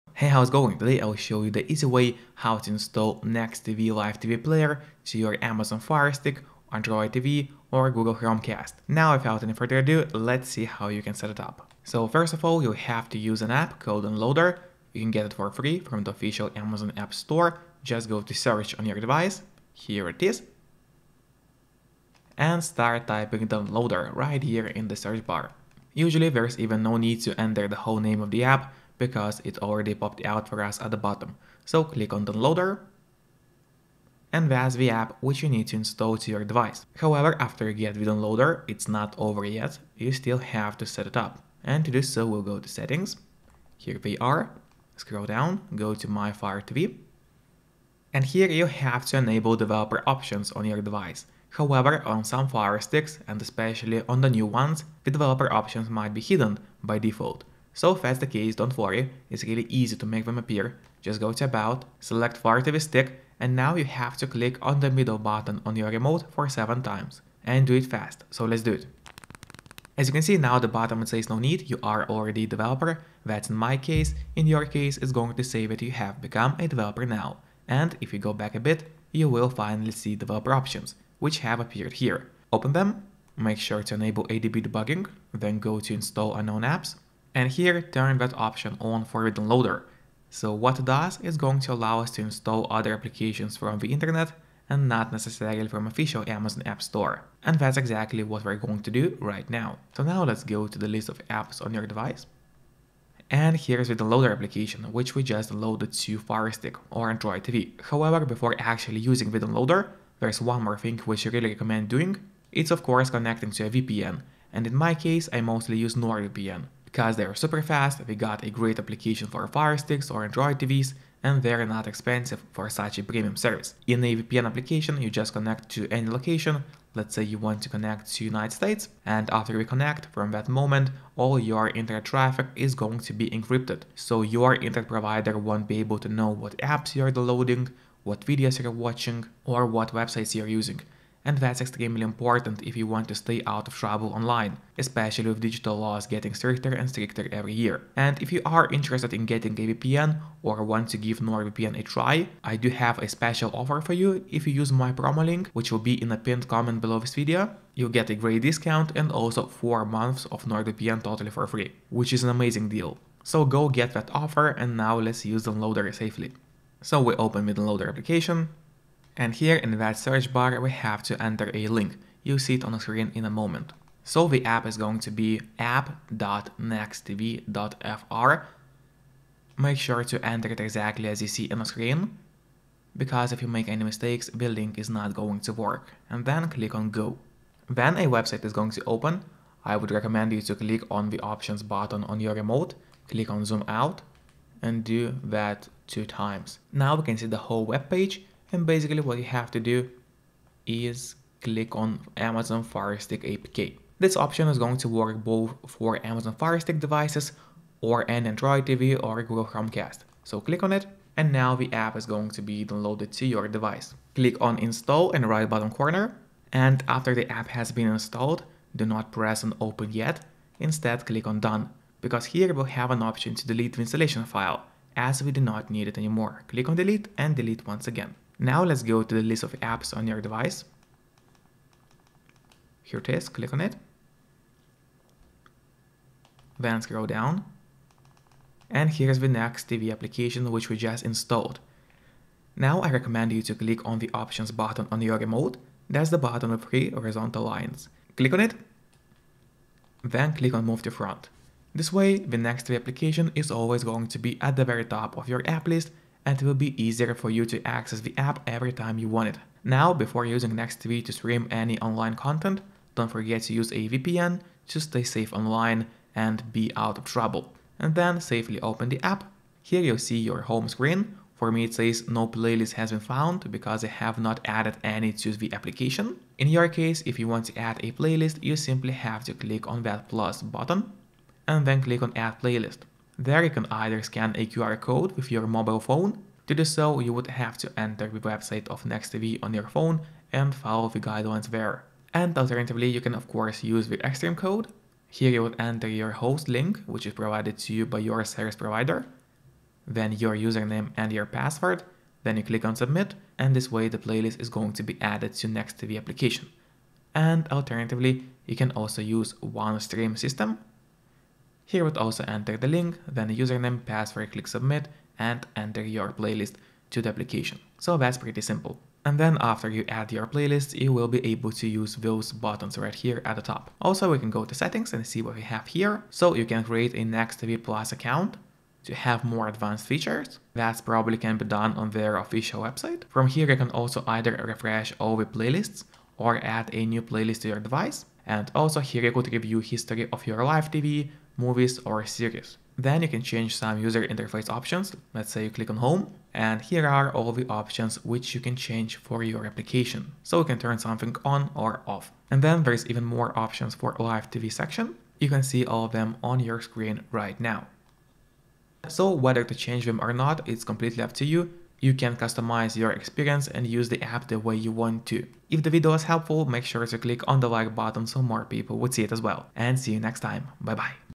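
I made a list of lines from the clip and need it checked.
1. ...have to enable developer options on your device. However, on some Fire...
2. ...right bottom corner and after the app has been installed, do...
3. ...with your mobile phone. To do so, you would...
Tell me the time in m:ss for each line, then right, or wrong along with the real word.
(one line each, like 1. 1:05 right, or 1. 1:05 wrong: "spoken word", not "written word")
1. 0:48 right
2. 3:35 right
3. 4:45 right.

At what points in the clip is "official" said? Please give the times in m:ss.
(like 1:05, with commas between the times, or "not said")
0:16, 1:35, 5:32.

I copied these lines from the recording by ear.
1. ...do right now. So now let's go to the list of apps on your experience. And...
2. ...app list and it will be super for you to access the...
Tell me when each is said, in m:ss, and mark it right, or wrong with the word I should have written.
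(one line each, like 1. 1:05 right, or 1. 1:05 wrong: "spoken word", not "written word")
1. 1:38 wrong: "device", not "experience"
2. 4:15 wrong: "easier", not "super".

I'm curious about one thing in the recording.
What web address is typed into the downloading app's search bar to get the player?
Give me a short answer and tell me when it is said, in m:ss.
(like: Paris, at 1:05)
app.nextv.fr, at 2:55.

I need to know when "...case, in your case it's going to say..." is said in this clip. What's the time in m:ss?
1:13.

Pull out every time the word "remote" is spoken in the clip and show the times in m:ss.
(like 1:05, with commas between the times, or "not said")
1:05, 3:12, 4:05.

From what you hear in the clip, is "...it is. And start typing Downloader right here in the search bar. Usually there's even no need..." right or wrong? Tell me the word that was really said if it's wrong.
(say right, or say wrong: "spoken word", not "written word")
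right.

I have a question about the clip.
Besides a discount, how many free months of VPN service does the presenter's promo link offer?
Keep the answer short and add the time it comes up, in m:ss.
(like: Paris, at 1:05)
4 months, at 2:39.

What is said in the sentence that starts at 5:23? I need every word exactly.
Also, we can go to settings and see what we have here.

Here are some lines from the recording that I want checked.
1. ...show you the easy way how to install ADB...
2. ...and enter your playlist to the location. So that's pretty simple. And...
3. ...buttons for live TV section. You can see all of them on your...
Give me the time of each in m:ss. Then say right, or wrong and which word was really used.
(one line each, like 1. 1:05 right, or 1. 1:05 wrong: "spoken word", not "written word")
1. 0:01 wrong: "NexTV", not "ADB"
2. 5:15 wrong: "application", not "location"
3. 5:53 wrong: "options", not "buttons".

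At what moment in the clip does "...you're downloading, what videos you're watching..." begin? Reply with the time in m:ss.
2:16.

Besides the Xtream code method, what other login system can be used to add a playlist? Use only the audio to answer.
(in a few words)
OneStream.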